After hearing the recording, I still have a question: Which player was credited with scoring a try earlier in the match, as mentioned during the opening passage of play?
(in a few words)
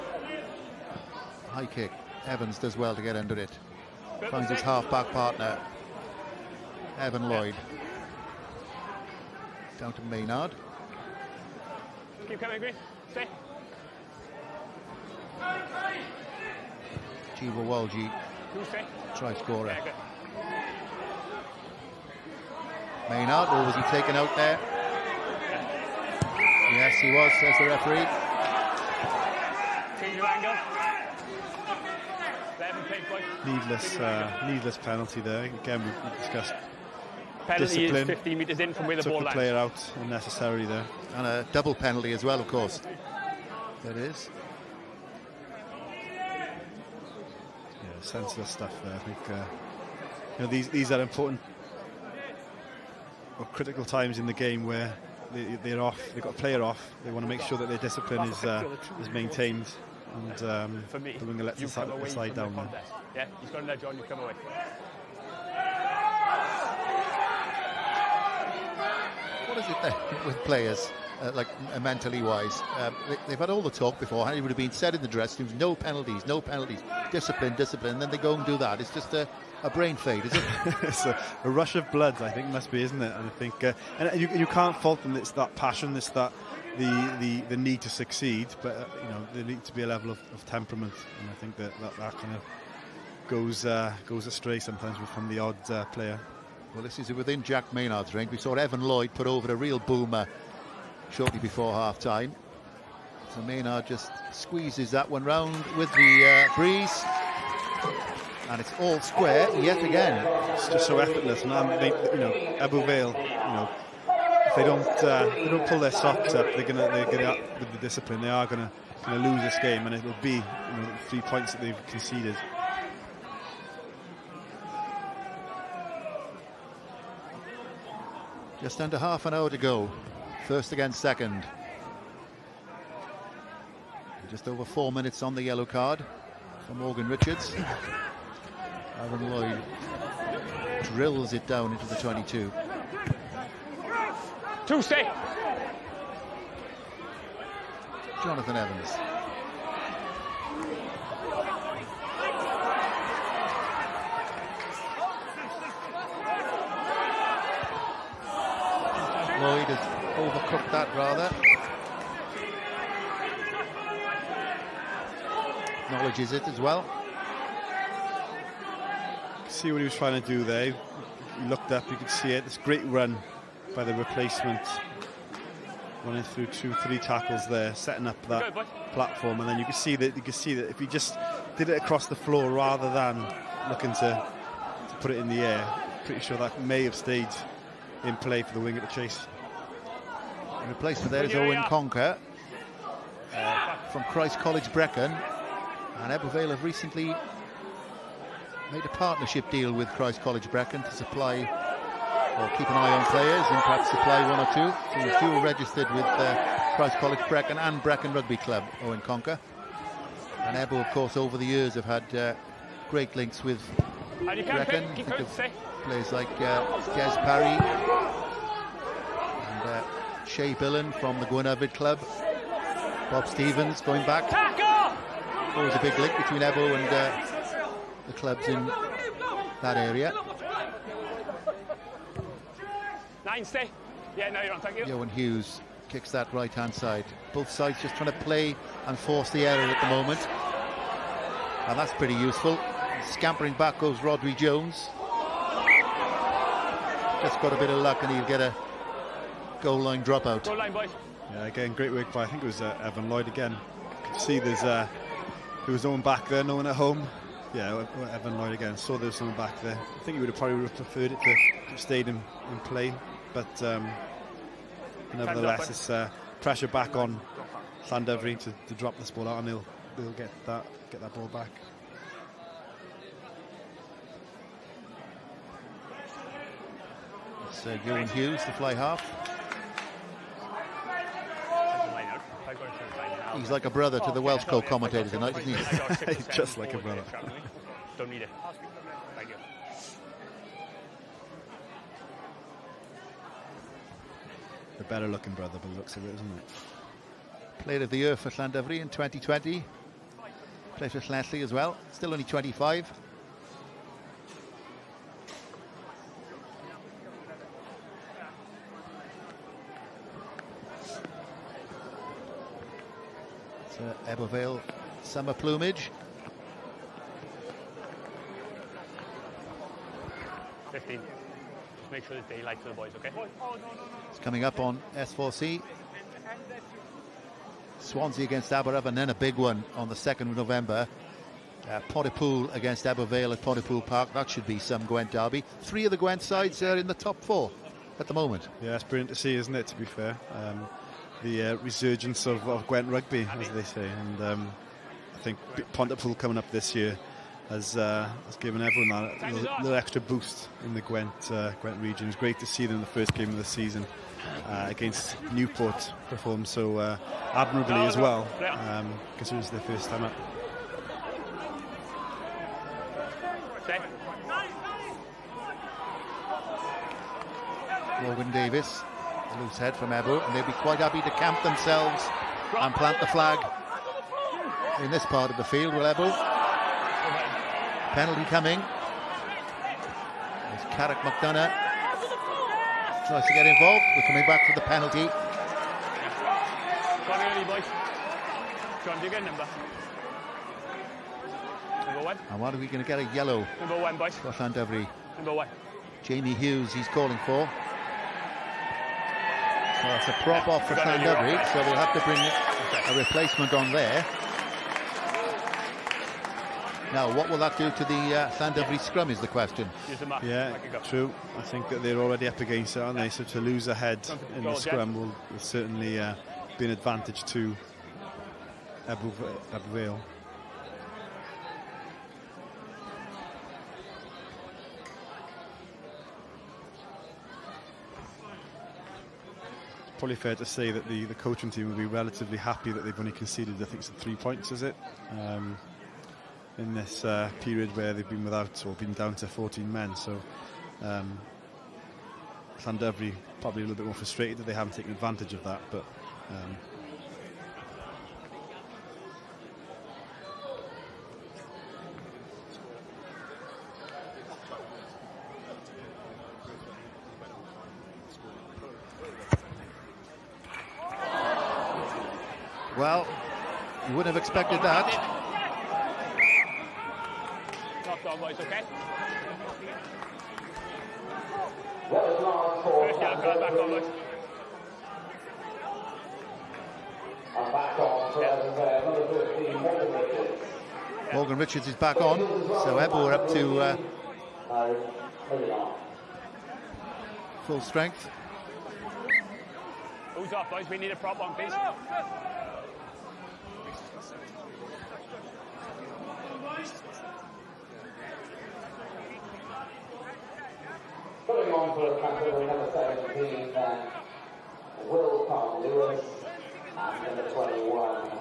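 Jiva Walji.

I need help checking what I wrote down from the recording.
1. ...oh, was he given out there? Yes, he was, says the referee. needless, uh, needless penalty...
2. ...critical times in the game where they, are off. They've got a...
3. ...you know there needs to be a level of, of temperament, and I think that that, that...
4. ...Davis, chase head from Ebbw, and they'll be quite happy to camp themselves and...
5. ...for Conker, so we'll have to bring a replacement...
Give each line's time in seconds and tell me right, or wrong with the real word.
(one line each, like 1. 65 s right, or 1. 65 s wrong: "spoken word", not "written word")
1. 23 s wrong: "taken", not "given"
2. 53 s right
3. 89 s right
4. 368 s wrong: "loose", not "chase"
5. 400 s wrong: "Llandovery", not "Conker".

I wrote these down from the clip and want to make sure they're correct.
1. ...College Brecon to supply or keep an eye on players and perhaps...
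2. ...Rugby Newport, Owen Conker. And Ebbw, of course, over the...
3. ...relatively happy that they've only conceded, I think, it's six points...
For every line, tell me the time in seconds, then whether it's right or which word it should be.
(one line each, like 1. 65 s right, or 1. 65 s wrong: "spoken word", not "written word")
1. 200 s right
2. 208 s wrong: "Club", not "Newport"
3. 431 s wrong: "three", not "six".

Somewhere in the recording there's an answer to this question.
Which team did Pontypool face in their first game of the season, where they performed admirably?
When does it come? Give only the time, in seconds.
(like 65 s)
355 s.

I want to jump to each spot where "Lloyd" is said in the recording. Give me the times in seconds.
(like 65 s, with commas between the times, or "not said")
7 s, 98 s, 139 s, 159 s, 253 s, 258 s.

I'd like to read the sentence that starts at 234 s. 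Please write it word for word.
Yeah, no, you're on, thank you.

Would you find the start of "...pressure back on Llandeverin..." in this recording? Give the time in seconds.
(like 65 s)
266 s.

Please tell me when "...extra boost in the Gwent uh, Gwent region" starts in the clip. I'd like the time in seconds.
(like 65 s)
349 s.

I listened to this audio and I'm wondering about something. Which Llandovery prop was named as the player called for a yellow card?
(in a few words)
Jamie Hughes.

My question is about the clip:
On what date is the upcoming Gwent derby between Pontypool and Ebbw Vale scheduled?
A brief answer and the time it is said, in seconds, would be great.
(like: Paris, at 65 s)
2nd of November, at 329 s.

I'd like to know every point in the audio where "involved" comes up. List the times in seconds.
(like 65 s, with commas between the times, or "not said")
383 s.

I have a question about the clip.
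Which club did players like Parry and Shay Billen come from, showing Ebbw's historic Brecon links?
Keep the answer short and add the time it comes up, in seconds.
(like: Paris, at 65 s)
Gwernyfed, at 221 s.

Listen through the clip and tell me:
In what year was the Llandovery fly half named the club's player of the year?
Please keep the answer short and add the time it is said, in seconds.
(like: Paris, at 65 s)
2020, at 298 s.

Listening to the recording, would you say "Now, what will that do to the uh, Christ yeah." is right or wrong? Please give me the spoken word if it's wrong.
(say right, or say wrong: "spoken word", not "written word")
wrong: "Sandobury", not "Christ".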